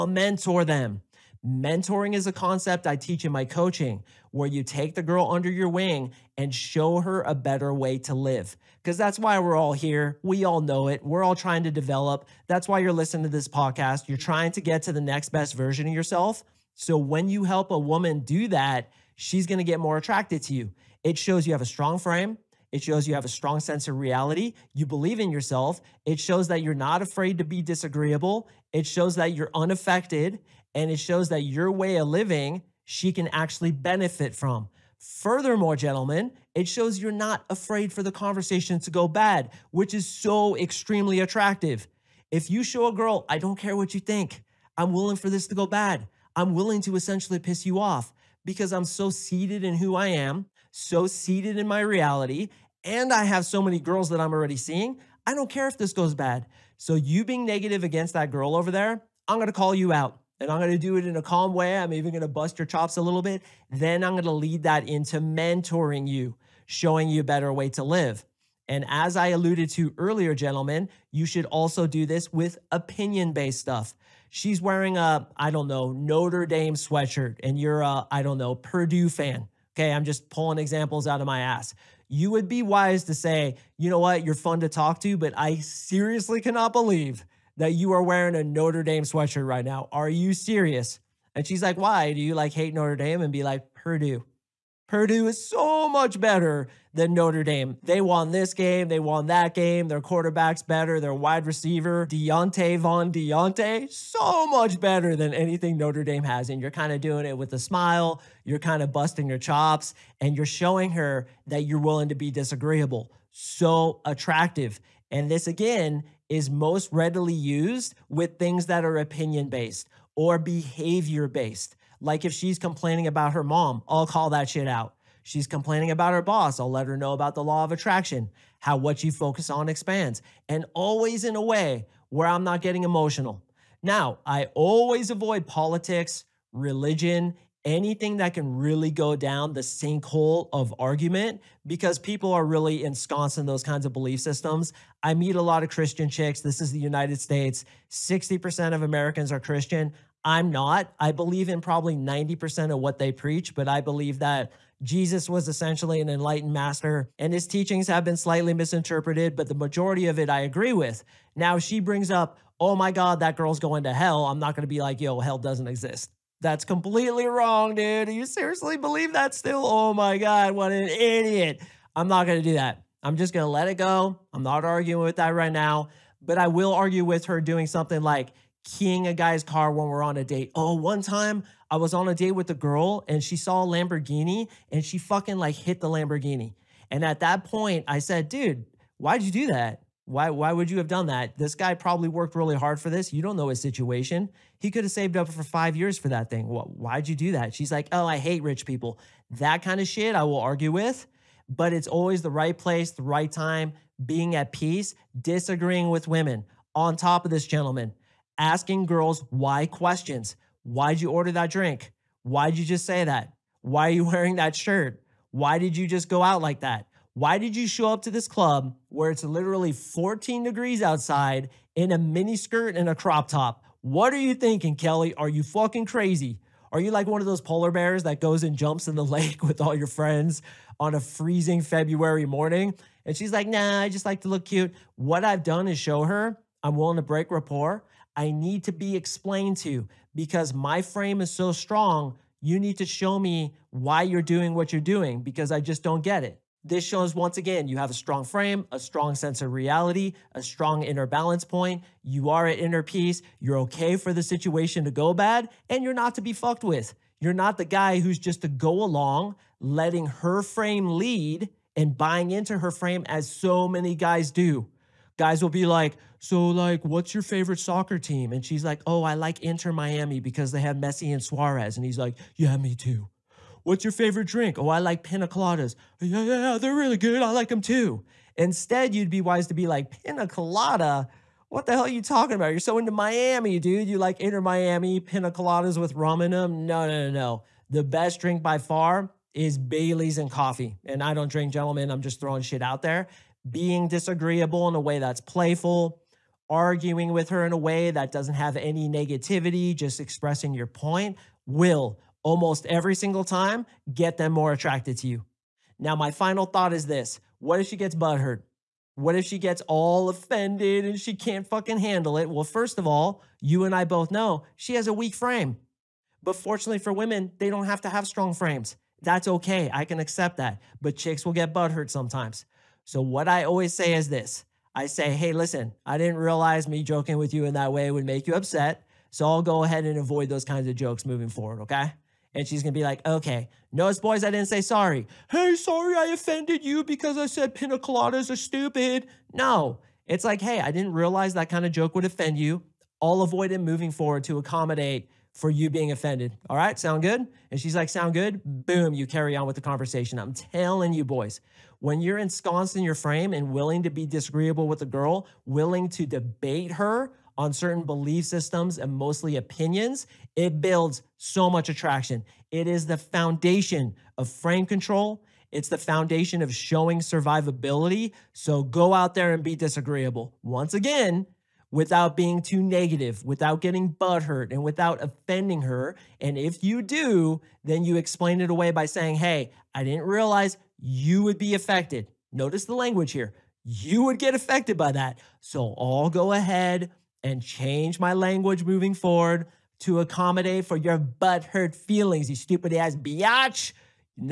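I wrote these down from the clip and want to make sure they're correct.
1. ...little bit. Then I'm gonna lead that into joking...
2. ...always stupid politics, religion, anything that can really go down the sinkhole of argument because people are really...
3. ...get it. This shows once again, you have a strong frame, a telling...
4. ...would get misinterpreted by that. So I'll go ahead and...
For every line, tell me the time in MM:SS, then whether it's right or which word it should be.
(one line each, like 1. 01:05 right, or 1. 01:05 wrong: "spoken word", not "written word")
1. 01:03 wrong: "mentoring", not "joking"
2. 02:14 wrong: "avoid", not "stupid"
3. 04:06 wrong: "strong", not "telling"
4. 06:24 wrong: "affected", not "misinterpreted".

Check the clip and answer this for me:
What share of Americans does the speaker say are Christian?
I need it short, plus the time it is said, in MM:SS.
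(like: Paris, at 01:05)
60%, at 02:27.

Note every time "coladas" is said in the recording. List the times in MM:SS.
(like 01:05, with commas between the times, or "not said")
04:35, 04:40, 04:45, 05:37.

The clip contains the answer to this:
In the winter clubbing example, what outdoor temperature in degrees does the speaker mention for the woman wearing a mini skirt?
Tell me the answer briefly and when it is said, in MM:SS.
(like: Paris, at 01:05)
14 degrees, at 03:39.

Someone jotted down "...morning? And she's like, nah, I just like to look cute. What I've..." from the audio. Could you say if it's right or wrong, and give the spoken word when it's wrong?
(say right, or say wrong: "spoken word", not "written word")
right.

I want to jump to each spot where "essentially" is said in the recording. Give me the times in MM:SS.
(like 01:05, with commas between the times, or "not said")
00:46, 02:35.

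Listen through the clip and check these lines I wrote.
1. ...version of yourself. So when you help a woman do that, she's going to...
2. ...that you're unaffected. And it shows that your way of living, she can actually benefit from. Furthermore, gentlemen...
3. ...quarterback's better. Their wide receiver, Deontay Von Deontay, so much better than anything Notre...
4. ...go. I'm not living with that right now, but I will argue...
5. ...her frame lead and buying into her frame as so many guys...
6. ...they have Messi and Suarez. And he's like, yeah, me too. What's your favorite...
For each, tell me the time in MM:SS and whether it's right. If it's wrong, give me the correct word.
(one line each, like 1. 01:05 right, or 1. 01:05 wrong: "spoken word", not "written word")
1. 00:15 right
2. 00:29 right
3. 01:40 right
4. 02:53 wrong: "arguing", not "living"
5. 04:20 right
6. 04:30 right.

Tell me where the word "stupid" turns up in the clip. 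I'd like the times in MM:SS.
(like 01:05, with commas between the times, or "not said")
05:38, 06:32.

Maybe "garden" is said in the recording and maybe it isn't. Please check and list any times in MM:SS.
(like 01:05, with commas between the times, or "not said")
not said.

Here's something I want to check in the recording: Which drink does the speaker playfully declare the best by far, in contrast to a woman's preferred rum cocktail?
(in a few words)
Bailey's and coffee.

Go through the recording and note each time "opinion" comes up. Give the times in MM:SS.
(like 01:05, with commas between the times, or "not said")
01:12, 01:58, 05:59.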